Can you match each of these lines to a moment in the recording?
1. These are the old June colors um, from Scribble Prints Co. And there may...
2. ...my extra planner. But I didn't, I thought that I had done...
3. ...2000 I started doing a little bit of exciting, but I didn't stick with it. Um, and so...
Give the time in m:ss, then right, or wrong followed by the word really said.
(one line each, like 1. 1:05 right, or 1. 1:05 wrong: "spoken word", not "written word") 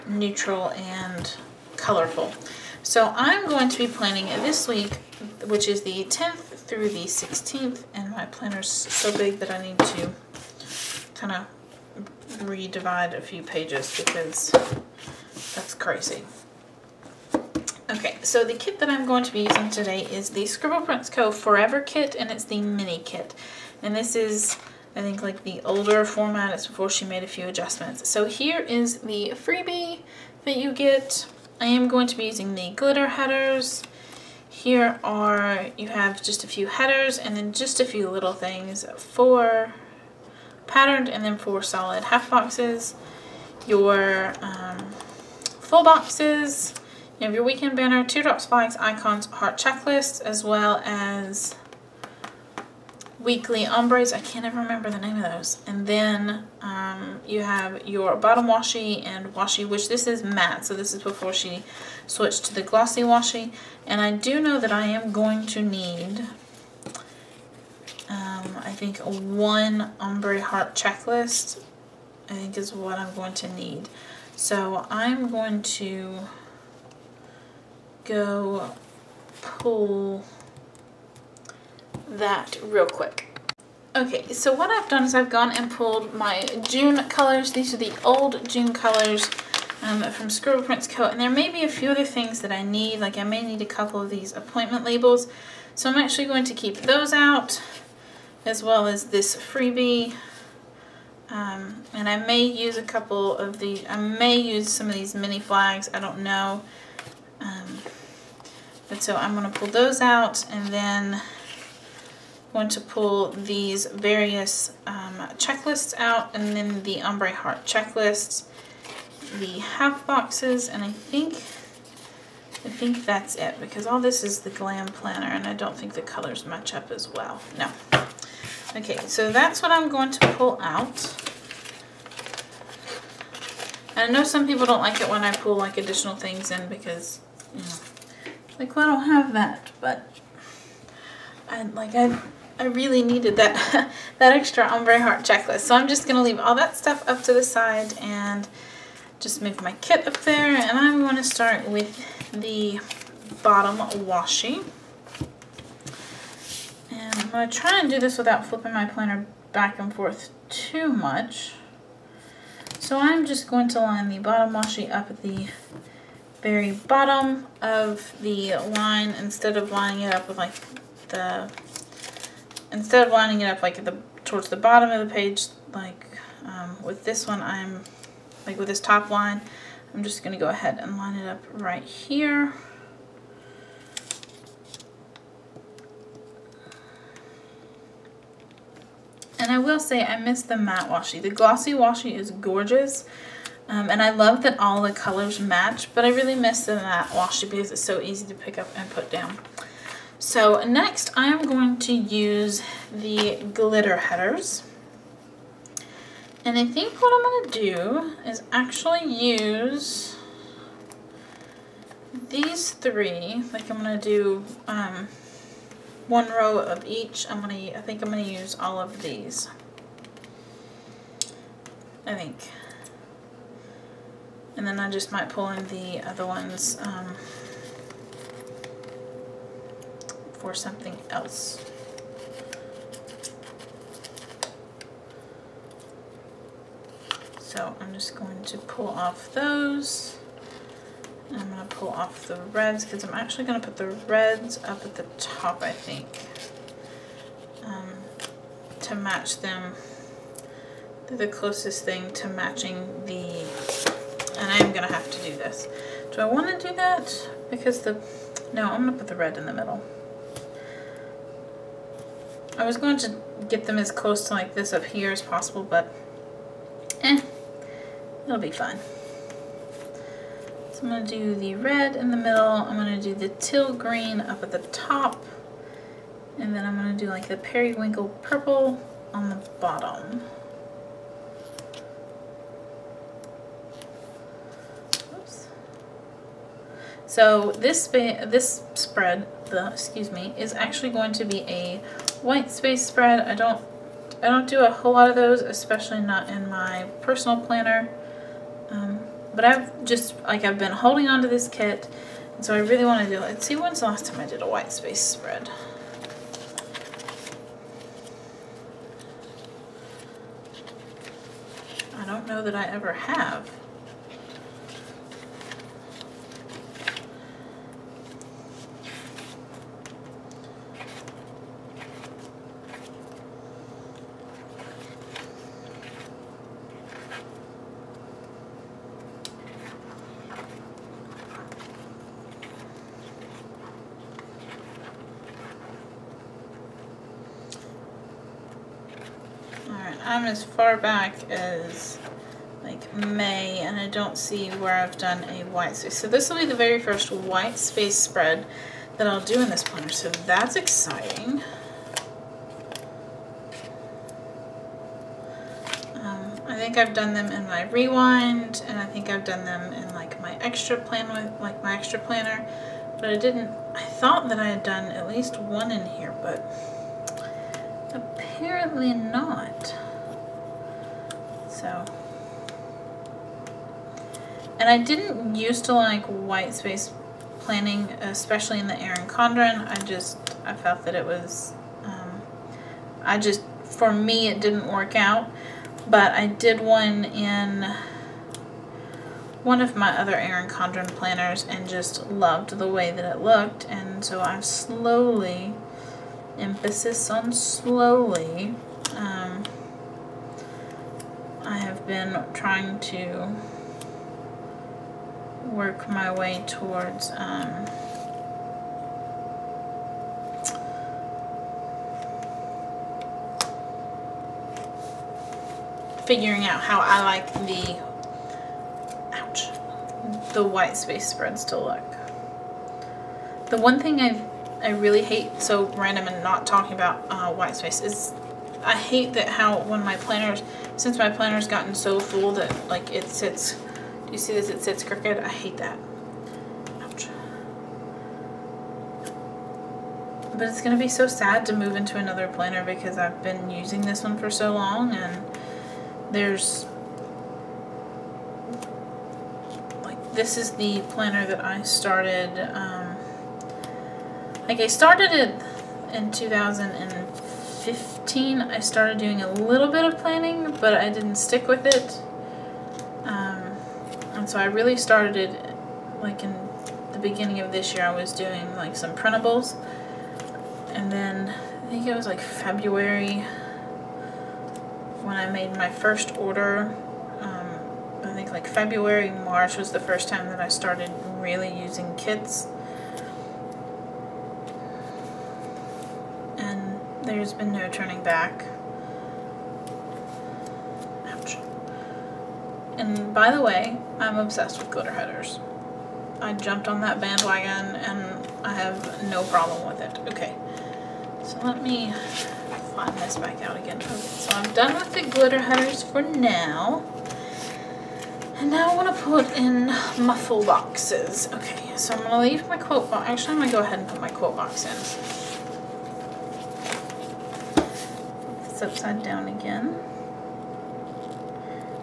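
1. 1:27 right
2. 6:01 right
3. 7:36 wrong: "planning", not "exciting".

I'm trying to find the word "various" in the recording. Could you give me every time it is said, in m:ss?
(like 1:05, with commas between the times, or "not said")
1:53.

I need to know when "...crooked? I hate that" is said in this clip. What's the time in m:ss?
7:14.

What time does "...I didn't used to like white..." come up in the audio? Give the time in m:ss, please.
6:14.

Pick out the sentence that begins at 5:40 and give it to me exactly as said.
I'm as far back as like May and I don't see where I've done a white space.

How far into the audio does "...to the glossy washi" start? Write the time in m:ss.
1:02.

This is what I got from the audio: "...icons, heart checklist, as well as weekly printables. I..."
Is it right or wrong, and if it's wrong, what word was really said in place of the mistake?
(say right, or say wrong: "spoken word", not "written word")
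wrong: "ombres", not "printables".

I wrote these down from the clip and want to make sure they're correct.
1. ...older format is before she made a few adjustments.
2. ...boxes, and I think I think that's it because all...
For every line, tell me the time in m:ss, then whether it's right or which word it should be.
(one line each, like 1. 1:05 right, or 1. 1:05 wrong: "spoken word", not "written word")
1. 0:25 right
2. 2:00 right.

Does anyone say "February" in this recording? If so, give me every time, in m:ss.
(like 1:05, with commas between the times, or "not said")
7:52, 7:58.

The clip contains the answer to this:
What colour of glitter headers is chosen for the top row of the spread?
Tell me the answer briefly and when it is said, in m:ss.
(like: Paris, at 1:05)
Teal green, at 4:33.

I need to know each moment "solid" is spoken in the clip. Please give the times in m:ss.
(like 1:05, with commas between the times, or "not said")
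0:41.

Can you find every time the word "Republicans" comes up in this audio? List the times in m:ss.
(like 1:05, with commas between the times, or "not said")
not said.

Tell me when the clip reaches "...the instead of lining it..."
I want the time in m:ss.
2:51.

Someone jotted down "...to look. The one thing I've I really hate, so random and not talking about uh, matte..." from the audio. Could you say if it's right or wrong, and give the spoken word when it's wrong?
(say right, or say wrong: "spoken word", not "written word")
wrong: "white", not "matte".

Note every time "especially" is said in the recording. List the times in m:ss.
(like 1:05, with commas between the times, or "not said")
4:55, 6:17.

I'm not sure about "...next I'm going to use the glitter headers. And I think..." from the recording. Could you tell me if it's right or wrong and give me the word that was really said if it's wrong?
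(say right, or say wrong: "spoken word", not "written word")
right.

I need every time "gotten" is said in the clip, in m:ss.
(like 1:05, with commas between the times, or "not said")
7:11.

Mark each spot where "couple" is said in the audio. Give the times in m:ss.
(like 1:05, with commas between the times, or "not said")
1:33, 1:42.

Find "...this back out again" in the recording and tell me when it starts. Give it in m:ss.
8:22.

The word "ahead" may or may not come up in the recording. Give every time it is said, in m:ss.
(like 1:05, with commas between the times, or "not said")
3:00, 8:33.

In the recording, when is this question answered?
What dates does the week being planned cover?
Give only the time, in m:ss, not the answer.
0:06.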